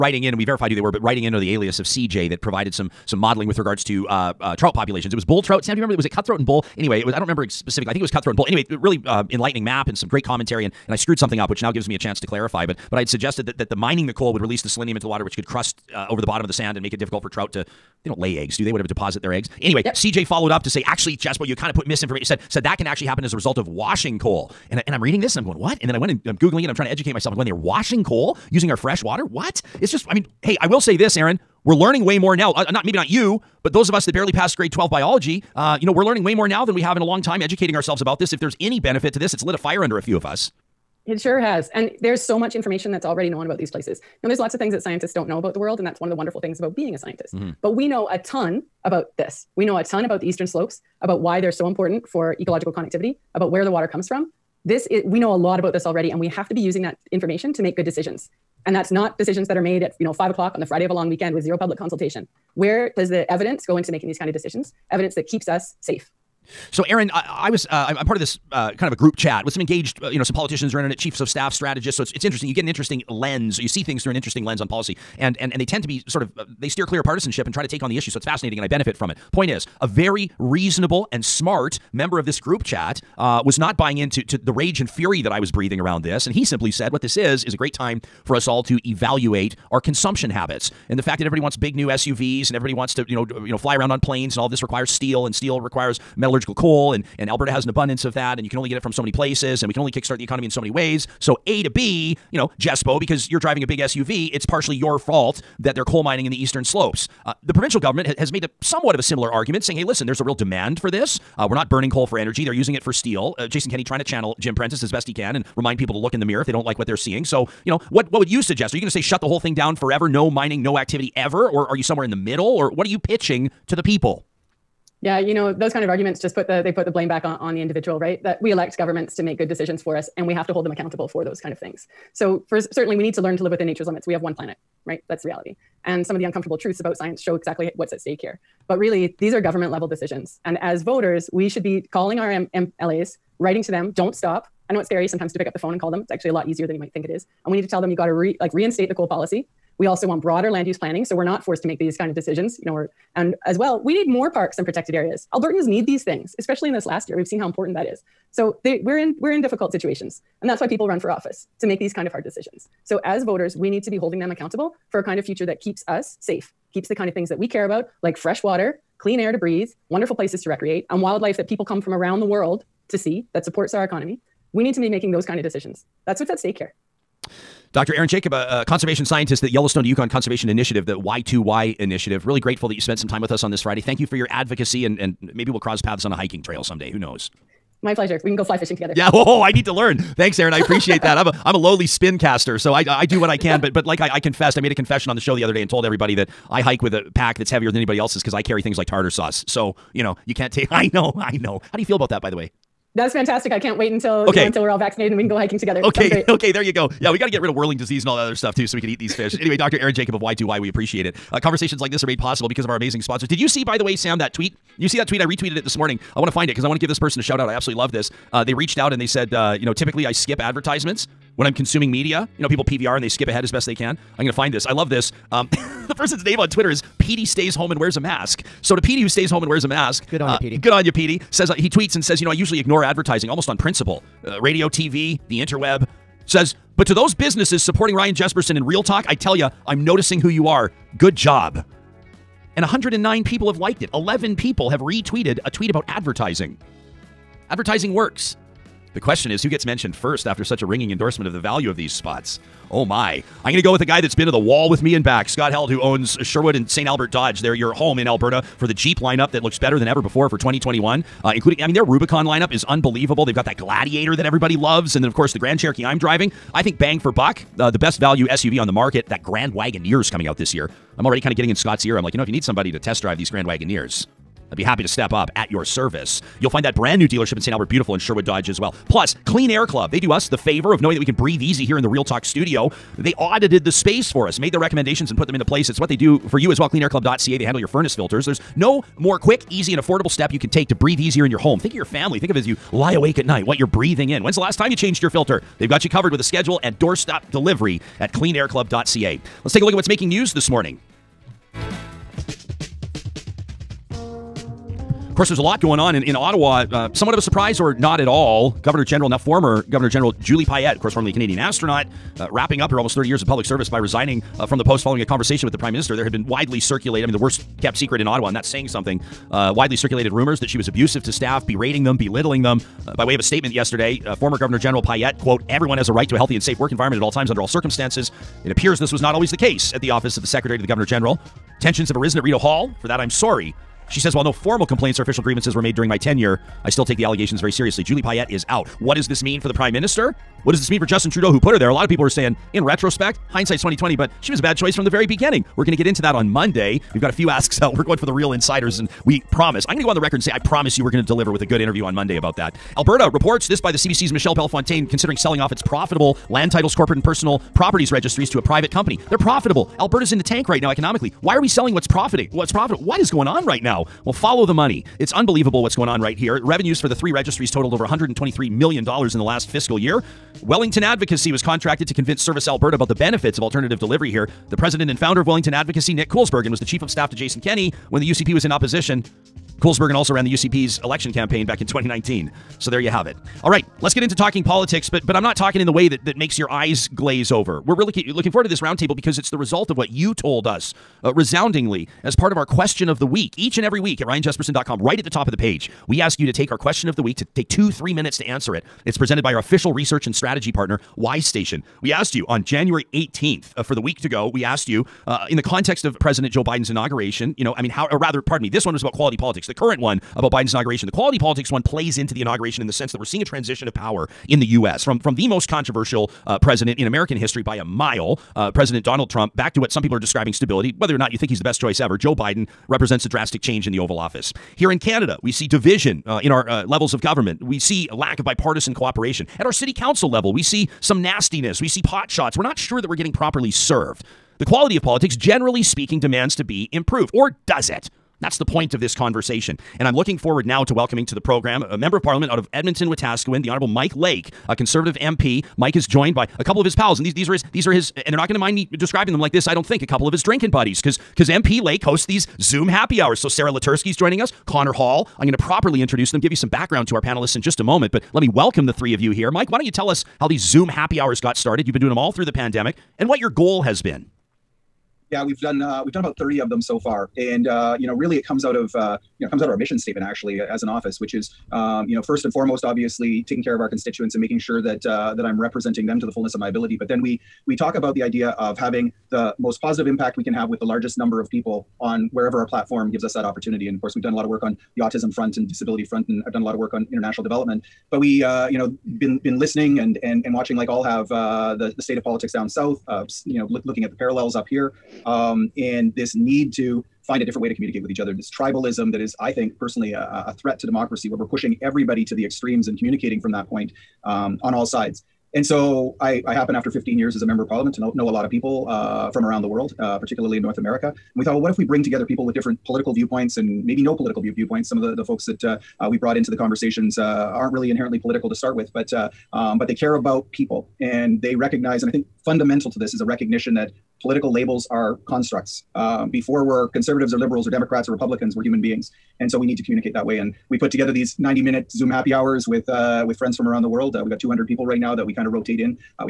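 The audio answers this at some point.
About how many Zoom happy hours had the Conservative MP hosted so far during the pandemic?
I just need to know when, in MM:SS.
07:46.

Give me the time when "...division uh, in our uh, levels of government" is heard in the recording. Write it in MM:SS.
07:05.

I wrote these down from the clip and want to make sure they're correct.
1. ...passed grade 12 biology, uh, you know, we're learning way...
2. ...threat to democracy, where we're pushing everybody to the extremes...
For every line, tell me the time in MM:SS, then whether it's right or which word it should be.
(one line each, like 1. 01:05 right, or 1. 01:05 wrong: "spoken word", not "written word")
1. 00:34 right
2. 08:20 right.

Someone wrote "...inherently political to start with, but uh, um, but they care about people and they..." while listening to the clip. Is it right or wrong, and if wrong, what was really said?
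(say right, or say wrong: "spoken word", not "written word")
right.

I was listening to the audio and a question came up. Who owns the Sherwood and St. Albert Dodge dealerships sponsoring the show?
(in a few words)
Scott Held.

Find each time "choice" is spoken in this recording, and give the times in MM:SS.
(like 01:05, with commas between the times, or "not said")
05:44, 07:01.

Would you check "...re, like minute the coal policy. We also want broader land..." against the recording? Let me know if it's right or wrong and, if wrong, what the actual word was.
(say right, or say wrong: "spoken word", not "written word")
wrong: "reinstate", not "minute".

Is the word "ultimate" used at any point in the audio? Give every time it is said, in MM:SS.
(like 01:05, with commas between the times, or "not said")
not said.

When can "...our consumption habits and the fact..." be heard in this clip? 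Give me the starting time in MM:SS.
01:29.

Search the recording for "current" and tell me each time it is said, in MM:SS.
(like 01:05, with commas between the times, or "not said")
06:49.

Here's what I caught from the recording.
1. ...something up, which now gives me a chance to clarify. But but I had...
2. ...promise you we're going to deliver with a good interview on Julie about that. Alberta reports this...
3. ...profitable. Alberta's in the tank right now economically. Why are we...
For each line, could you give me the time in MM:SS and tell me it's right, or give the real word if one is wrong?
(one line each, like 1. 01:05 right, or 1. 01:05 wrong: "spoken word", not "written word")
1. 00:11 right
2. 05:50 wrong: "Monday", not "Julie"
3. 05:59 right.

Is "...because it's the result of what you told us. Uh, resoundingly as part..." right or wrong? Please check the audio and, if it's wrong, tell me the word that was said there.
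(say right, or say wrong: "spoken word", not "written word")
right.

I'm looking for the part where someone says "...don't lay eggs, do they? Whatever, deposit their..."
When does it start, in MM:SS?
00:18.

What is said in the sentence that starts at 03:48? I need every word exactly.
So to Petey who stays home and wears a mask, good on uh, you, Petey.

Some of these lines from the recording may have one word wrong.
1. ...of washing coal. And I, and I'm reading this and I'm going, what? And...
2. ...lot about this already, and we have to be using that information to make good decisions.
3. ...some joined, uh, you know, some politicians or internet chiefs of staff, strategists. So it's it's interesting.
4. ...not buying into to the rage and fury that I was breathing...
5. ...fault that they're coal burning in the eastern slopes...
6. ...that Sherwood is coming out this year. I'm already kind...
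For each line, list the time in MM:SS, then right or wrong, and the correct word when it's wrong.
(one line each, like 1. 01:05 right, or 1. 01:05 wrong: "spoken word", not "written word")
1. 00:23 right
2. 00:55 right
3. 01:09 wrong: "engaged", not "joined"
4. 01:23 right
5. 01:44 wrong: "mining", not "burning"
6. 04:29 wrong: "Grand", not "Sherwood".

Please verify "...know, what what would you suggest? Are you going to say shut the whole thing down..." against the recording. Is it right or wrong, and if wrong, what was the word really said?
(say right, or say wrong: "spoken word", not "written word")
right.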